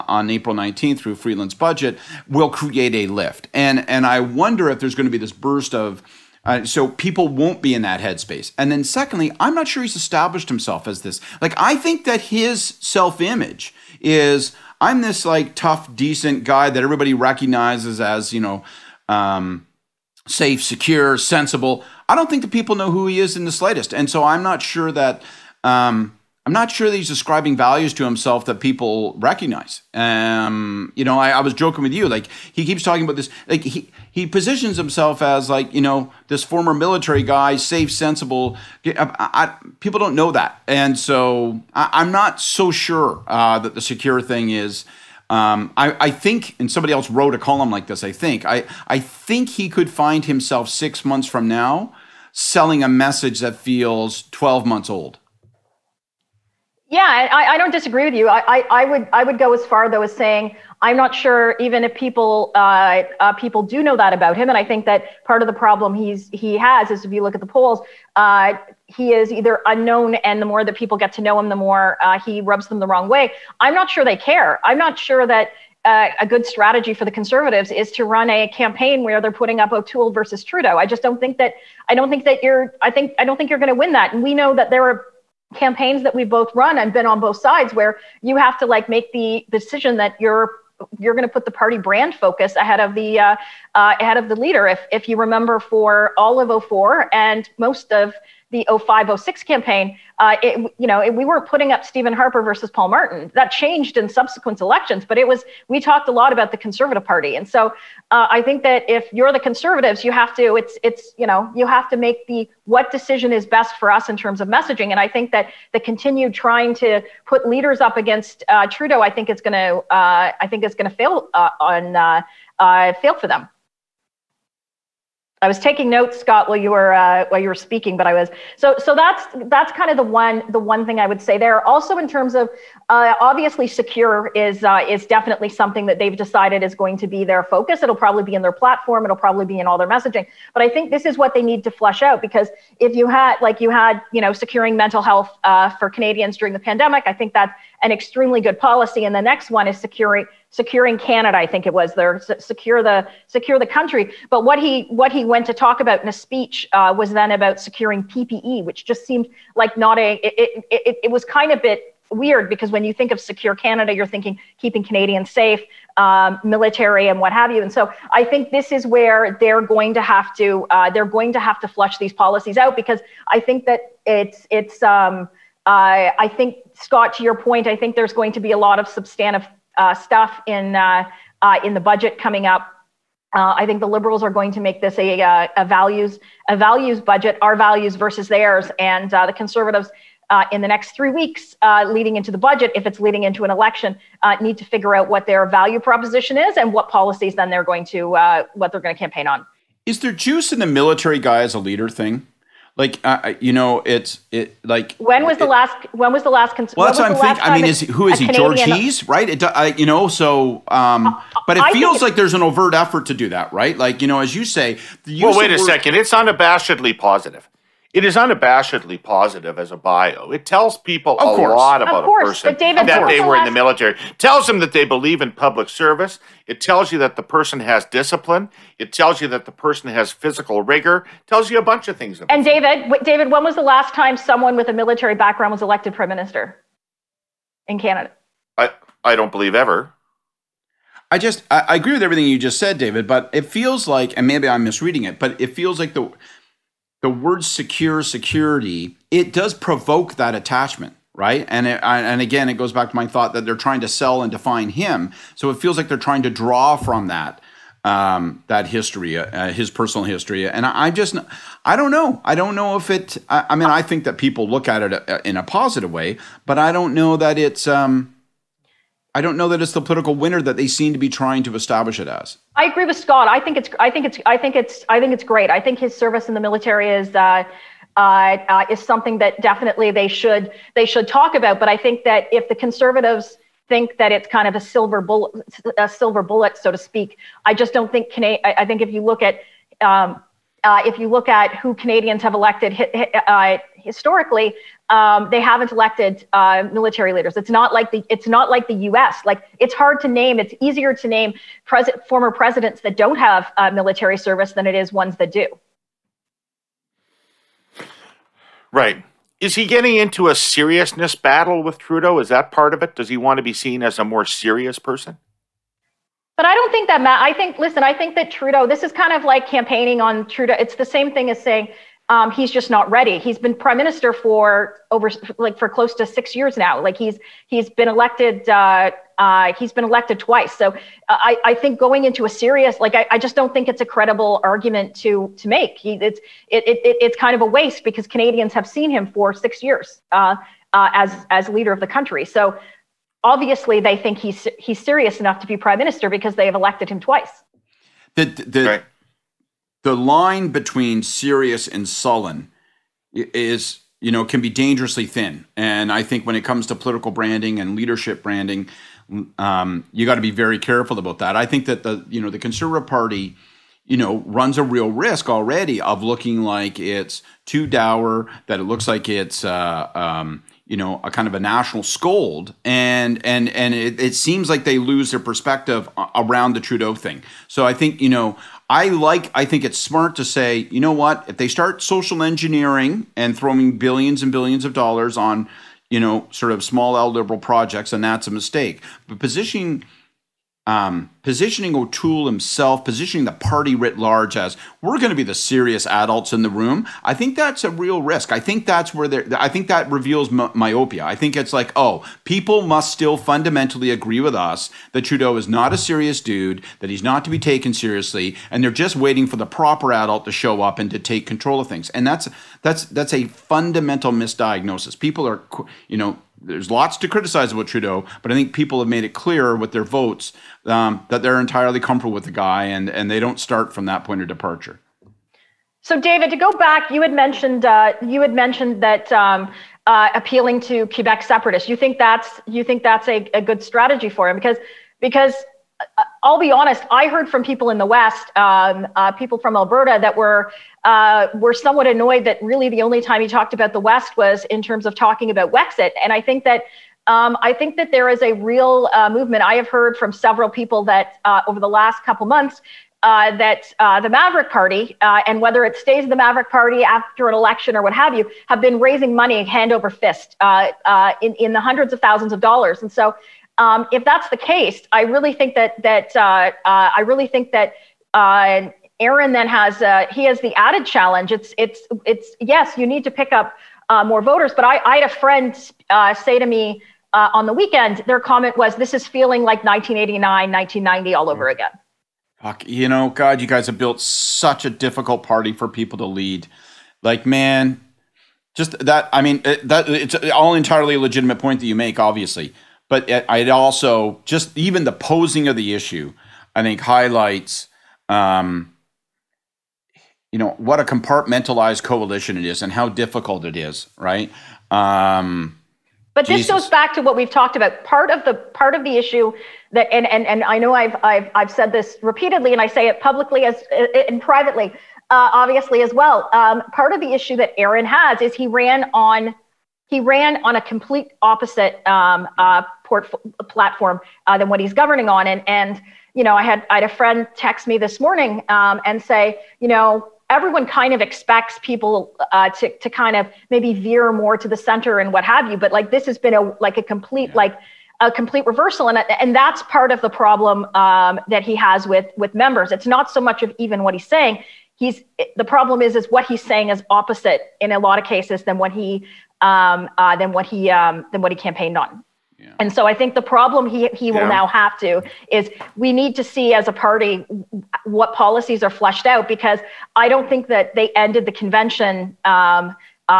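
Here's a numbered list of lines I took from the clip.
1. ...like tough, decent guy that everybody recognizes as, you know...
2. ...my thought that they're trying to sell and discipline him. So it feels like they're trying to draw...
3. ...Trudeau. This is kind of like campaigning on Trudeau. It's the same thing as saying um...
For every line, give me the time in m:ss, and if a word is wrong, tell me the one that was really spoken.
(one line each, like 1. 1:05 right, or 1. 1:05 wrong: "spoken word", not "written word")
1. 0:15 right
2. 4:12 wrong: "define", not "discipline"
3. 5:18 right.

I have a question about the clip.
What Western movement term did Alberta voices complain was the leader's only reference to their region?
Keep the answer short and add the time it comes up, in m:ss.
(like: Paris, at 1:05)
Wexit, at 7:25.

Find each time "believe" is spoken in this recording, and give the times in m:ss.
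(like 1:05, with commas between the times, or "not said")
3:44, 3:59.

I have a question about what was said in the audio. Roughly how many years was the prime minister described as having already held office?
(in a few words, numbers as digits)
6.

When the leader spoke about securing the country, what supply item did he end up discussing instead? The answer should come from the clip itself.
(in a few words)
PPE.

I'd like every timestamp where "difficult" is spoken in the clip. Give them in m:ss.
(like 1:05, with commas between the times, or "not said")
8:04, 8:22.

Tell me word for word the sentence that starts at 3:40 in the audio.
It tells people of a course.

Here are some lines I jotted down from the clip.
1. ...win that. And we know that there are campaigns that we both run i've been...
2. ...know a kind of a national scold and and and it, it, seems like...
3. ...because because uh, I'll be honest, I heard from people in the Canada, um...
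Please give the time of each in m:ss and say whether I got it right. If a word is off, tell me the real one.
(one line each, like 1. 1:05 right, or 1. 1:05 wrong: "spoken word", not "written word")
1. 1:23 right
2. 6:10 right
3. 7:14 wrong: "West", not "Canada".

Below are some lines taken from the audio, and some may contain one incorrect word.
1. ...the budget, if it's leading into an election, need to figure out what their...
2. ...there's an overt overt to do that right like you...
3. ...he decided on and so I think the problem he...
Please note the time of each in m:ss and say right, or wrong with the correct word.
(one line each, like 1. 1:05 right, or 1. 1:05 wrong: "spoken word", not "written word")
1. 3:12 right
2. 3:32 wrong: "effort", not "overt"
3. 9:11 wrong: "campaigned", not "decided".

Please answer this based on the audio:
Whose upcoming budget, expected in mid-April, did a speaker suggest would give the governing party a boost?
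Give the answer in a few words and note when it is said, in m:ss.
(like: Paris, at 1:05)
Freeland, at 0:01.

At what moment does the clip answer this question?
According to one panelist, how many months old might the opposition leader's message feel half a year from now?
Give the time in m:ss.
0:54.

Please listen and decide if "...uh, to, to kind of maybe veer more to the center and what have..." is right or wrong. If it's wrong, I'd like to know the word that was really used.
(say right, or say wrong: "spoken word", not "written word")
right.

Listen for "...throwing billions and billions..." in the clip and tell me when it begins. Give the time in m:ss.
6:23.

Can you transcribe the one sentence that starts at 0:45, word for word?
Um, I, I, think, and somebody else wrote a column like this.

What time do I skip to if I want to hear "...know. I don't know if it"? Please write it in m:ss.
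4:21.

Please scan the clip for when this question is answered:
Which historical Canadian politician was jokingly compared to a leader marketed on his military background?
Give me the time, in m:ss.
3:28.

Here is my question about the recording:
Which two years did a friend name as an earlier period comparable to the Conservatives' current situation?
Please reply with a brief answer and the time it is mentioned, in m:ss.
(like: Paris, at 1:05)
1989, 1990, at 7:59.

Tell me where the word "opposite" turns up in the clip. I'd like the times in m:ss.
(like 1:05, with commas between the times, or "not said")
8:41, 9:06.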